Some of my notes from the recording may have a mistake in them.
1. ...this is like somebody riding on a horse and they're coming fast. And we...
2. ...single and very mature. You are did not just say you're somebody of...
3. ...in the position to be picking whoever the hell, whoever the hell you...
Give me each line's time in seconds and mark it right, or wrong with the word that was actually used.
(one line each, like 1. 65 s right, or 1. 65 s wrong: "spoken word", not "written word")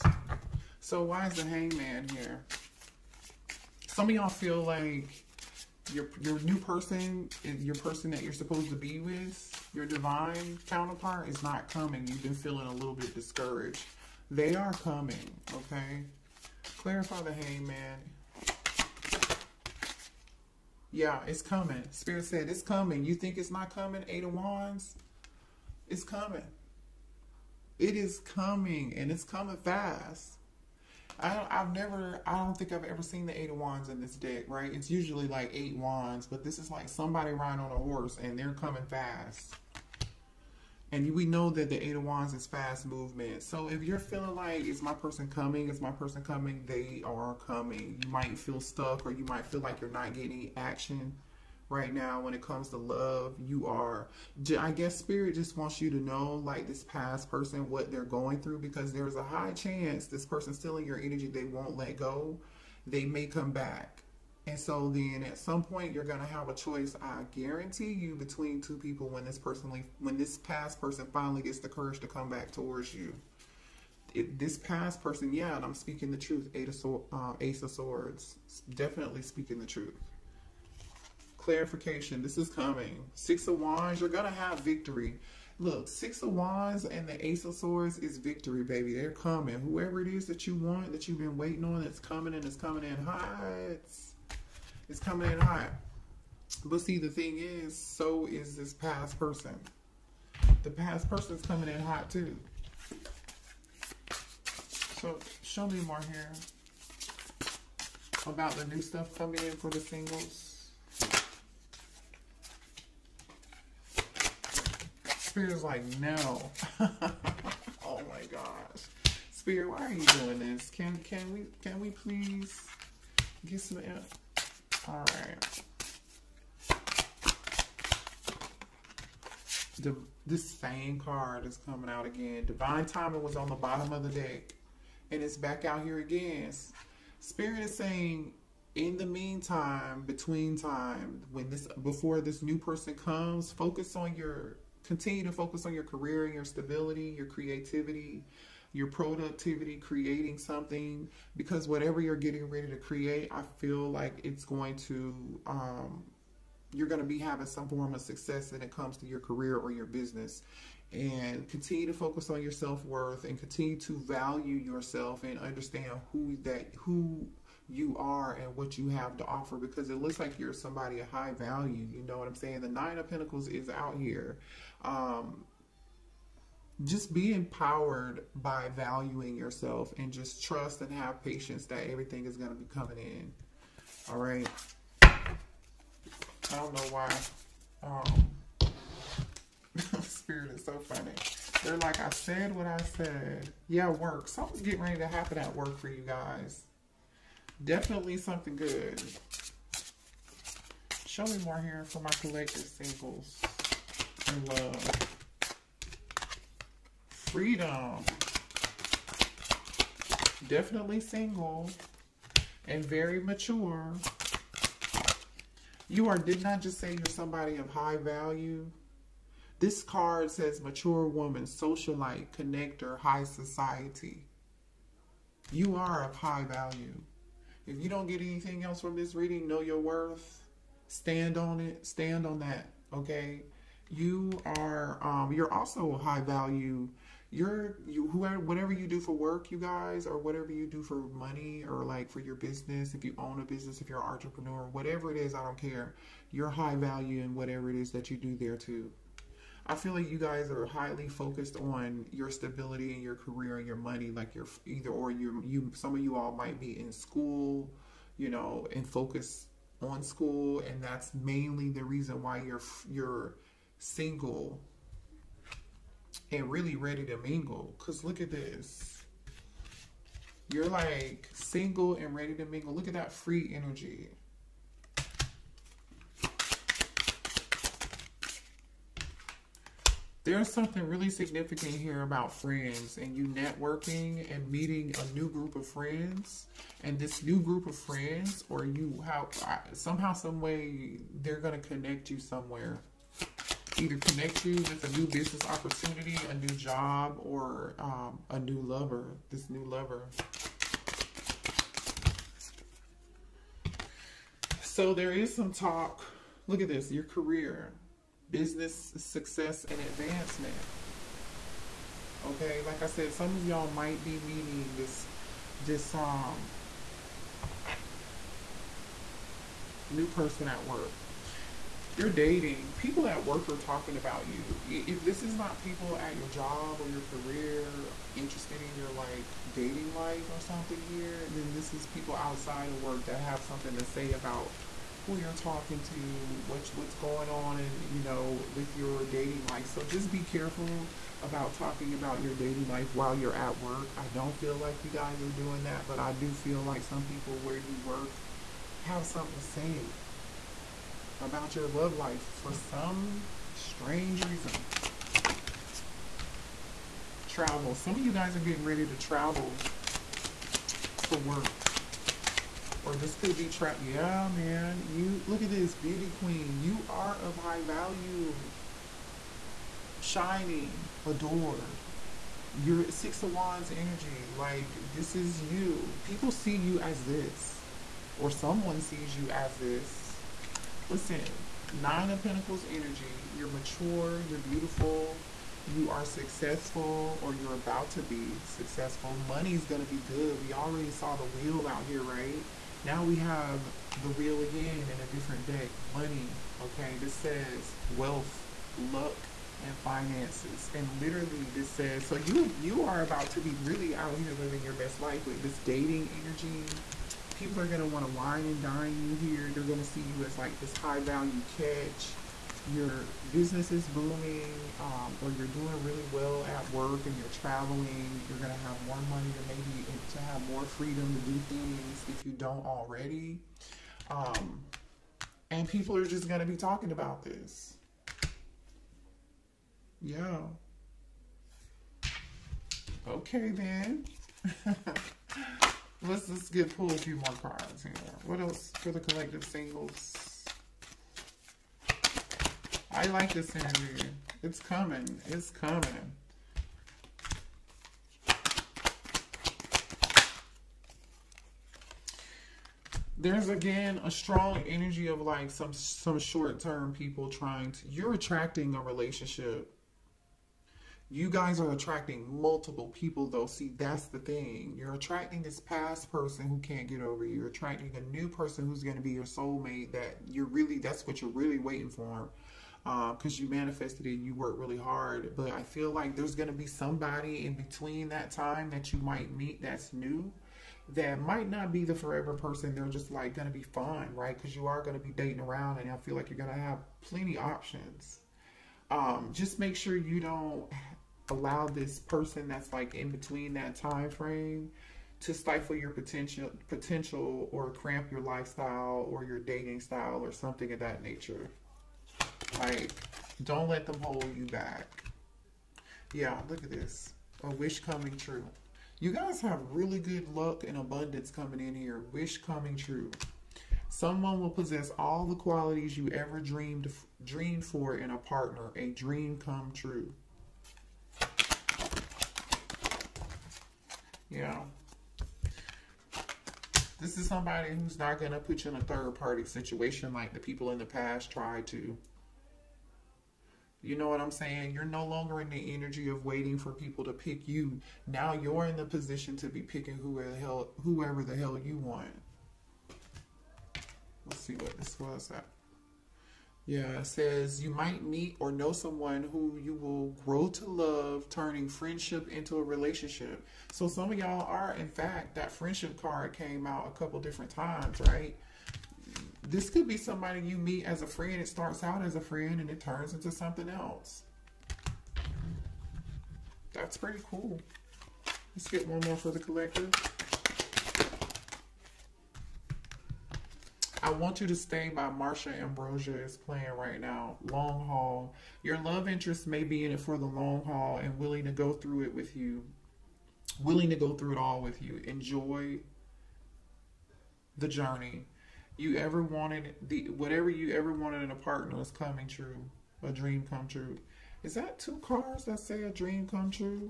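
1. 36 s right
2. 211 s right
3. 538 s right.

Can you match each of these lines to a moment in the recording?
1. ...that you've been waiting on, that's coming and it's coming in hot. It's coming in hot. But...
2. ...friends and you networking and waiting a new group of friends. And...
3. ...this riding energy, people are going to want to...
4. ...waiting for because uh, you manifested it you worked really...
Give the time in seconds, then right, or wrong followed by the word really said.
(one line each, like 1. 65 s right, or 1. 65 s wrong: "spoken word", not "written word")
1. 90 s right
2. 282 s wrong: "meeting", not "waiting"
3. 405 s wrong: "dating", not "riding"
4. 471 s right.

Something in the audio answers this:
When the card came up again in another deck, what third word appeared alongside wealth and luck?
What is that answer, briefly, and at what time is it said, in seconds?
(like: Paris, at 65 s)
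finances, at 399 s.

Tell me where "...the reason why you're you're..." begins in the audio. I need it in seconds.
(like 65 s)
261 s.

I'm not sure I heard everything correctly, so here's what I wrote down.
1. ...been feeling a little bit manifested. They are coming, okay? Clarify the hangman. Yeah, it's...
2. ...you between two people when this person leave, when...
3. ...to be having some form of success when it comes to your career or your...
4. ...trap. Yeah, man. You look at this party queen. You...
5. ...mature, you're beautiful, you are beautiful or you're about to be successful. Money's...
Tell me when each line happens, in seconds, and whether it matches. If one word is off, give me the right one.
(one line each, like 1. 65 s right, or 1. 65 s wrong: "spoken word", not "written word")
1. 12 s wrong: "discouraged", not "manifested"
2. 67 s right
3. 157 s right
4. 363 s wrong: "beauty", not "party"
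5. 383 s wrong: "successful", not "beautiful".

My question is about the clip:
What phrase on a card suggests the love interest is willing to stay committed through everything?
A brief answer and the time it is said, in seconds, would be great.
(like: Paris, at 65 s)
the long haul, at 580 s.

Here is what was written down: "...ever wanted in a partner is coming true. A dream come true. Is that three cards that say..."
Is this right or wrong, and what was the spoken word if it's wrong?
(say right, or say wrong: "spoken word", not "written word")
wrong: "two", not "three".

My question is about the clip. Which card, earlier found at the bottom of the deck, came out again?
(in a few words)
Divine Timing.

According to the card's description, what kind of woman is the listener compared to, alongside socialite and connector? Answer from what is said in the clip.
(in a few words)
mature woman.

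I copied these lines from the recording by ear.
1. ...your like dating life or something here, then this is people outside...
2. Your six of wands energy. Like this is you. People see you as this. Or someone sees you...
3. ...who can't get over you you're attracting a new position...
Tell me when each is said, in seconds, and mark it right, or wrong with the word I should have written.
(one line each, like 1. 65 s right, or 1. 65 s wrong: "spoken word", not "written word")
1. 328 s right
2. 372 s right
3. 466 s wrong: "person", not "position".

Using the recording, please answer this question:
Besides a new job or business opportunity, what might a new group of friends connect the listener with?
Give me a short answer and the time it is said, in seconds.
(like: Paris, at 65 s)
a new lover, at 298 s.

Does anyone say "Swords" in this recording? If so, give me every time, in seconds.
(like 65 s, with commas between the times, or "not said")
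77 s, 87 s.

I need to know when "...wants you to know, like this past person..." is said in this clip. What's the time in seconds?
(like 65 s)
55 s.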